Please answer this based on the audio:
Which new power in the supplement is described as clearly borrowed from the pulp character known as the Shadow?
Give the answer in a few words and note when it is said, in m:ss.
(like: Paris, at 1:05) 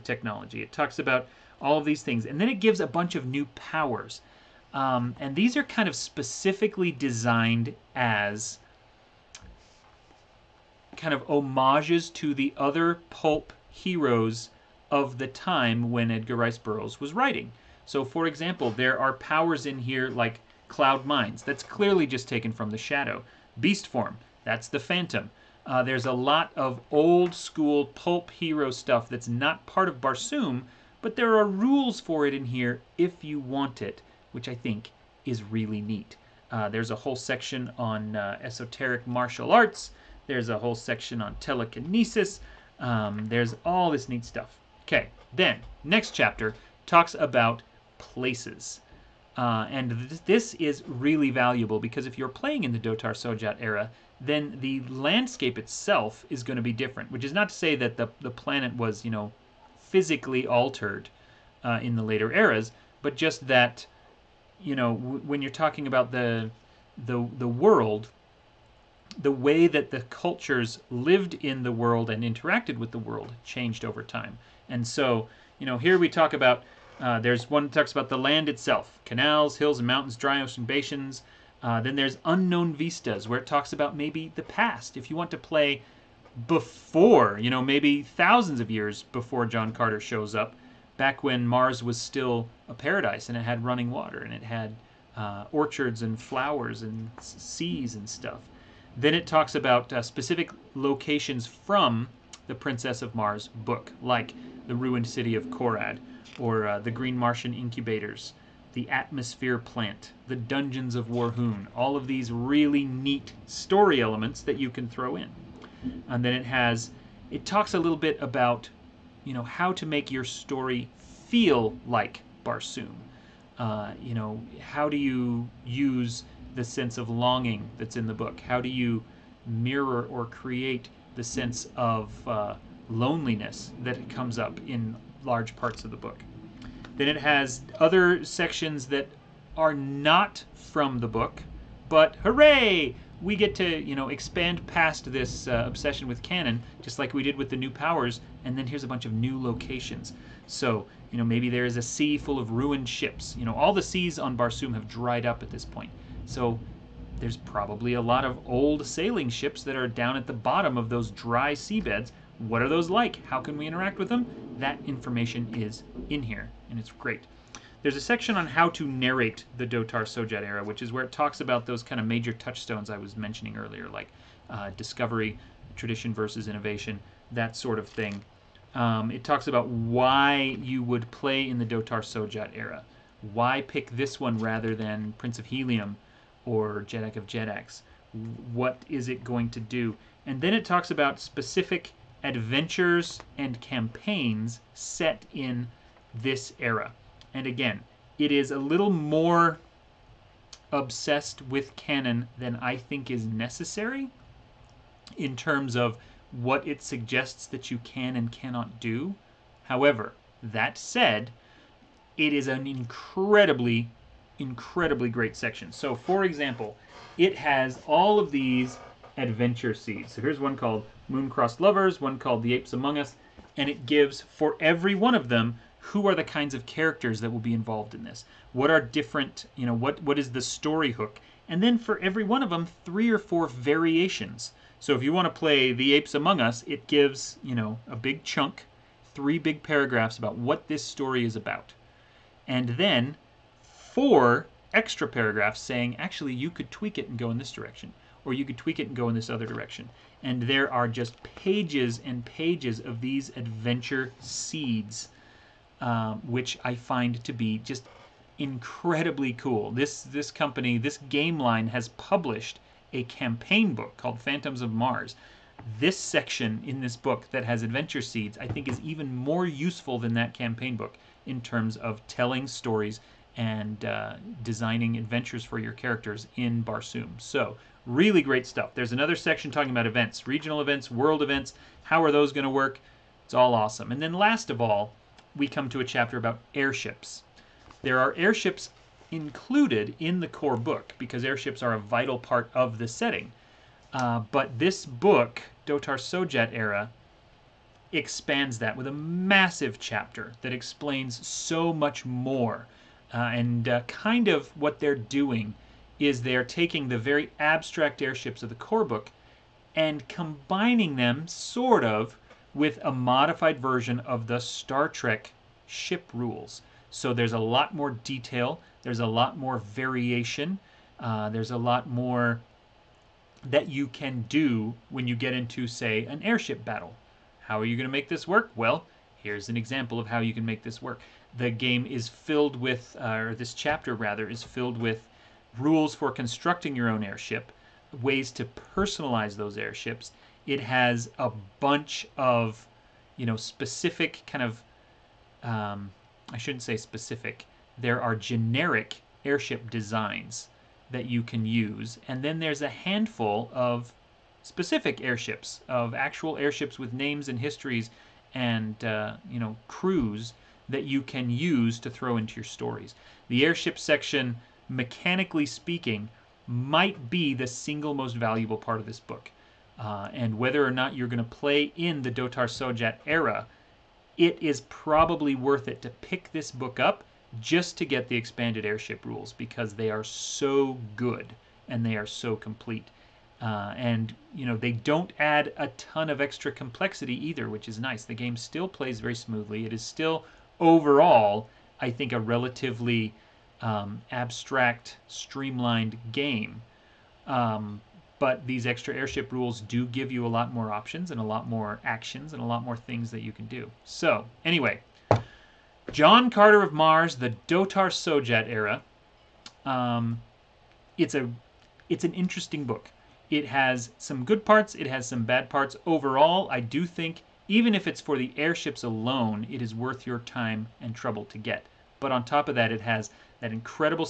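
Cloud minds, at 0:20.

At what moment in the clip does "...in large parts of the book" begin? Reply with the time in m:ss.
2:14.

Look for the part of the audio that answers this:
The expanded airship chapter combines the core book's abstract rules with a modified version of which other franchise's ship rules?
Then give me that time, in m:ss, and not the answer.
5:14.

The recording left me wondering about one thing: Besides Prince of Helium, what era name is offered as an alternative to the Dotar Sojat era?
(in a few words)
Jeddak of Jeddaks.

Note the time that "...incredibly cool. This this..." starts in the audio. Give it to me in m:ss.
4:18.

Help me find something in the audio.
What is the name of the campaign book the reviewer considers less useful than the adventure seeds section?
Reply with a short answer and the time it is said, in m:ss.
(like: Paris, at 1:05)
Phantoms of Mars, at 4:24.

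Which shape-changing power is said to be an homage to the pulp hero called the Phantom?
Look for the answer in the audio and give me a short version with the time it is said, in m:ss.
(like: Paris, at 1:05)
Beast Form, at 0:23.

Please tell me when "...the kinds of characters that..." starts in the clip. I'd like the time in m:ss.
3:46.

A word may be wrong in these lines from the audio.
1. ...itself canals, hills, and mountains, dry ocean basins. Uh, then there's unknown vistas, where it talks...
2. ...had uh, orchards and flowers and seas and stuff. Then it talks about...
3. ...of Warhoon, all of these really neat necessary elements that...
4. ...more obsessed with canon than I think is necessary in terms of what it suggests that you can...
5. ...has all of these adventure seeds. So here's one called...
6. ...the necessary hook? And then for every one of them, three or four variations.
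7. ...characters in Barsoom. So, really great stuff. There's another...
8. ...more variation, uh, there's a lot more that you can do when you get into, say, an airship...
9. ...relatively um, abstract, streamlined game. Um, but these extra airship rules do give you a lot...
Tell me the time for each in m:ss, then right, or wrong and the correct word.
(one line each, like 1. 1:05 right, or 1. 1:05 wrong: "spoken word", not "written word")
1. 1:18 right
2. 1:34 right
3. 1:50 wrong: "story", not "necessary"
4. 3:18 right
5. 3:37 right
6. 3:50 wrong: "story", not "necessary"
7. 4:35 right
8. 5:19 right
9. 6:32 right.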